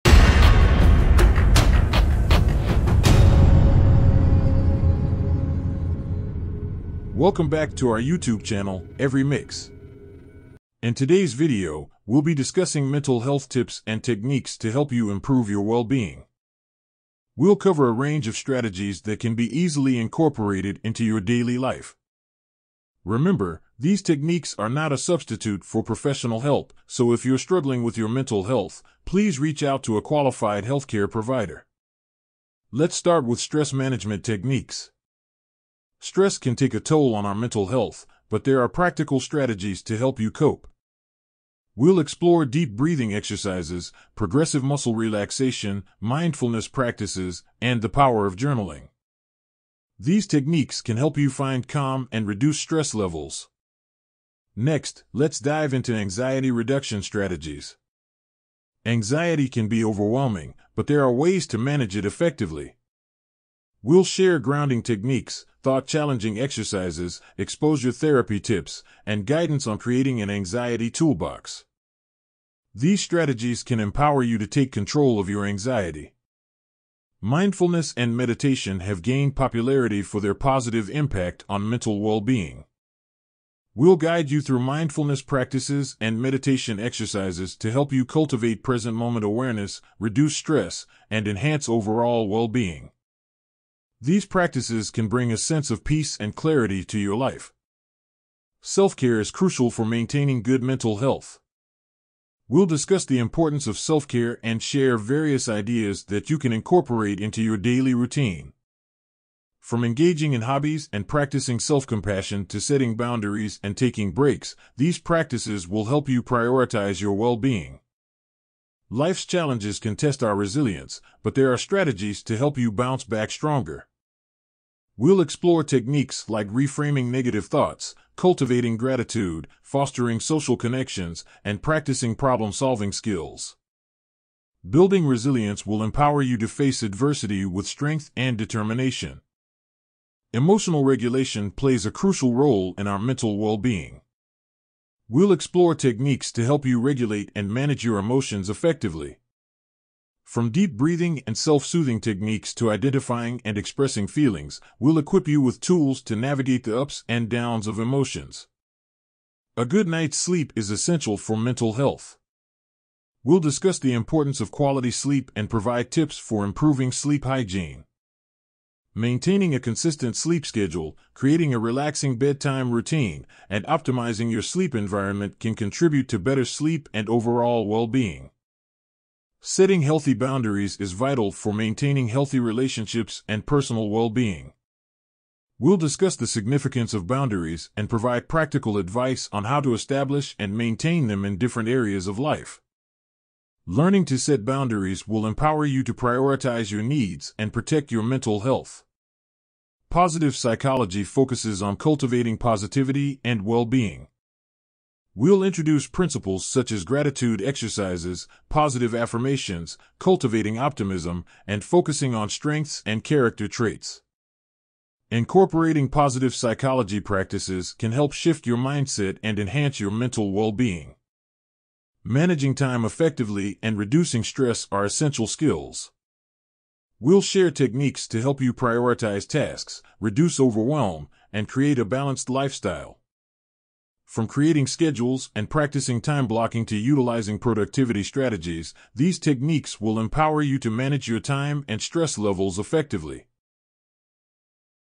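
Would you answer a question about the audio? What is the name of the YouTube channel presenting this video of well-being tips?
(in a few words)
Every Mix.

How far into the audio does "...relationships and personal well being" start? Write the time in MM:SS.
03:02.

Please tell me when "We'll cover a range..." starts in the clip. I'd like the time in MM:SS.
00:17.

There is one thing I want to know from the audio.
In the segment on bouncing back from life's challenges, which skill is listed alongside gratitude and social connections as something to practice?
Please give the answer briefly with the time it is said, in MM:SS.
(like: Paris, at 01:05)
problem solving skills, at 02:12.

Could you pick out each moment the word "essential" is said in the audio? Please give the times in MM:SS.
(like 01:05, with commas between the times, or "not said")
02:40, 03:44.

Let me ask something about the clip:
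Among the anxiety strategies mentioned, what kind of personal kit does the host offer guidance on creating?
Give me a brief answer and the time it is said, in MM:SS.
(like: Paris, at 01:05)
anxiety toolbox, at 01:10.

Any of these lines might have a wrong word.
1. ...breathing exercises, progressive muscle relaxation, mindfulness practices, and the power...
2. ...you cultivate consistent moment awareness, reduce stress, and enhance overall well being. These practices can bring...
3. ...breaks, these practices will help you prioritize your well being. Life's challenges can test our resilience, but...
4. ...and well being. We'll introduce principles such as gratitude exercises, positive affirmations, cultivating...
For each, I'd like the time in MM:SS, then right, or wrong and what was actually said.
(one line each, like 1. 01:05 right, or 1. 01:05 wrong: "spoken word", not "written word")
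1. 00:42 right
2. 01:27 wrong: "present", not "consistent"
3. 01:54 right
4. 03:23 right.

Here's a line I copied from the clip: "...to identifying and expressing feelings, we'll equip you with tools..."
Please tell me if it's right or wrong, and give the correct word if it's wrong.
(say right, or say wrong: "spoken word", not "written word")
right.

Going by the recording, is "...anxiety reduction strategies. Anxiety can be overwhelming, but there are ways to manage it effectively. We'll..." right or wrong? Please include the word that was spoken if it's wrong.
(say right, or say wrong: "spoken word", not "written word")
right.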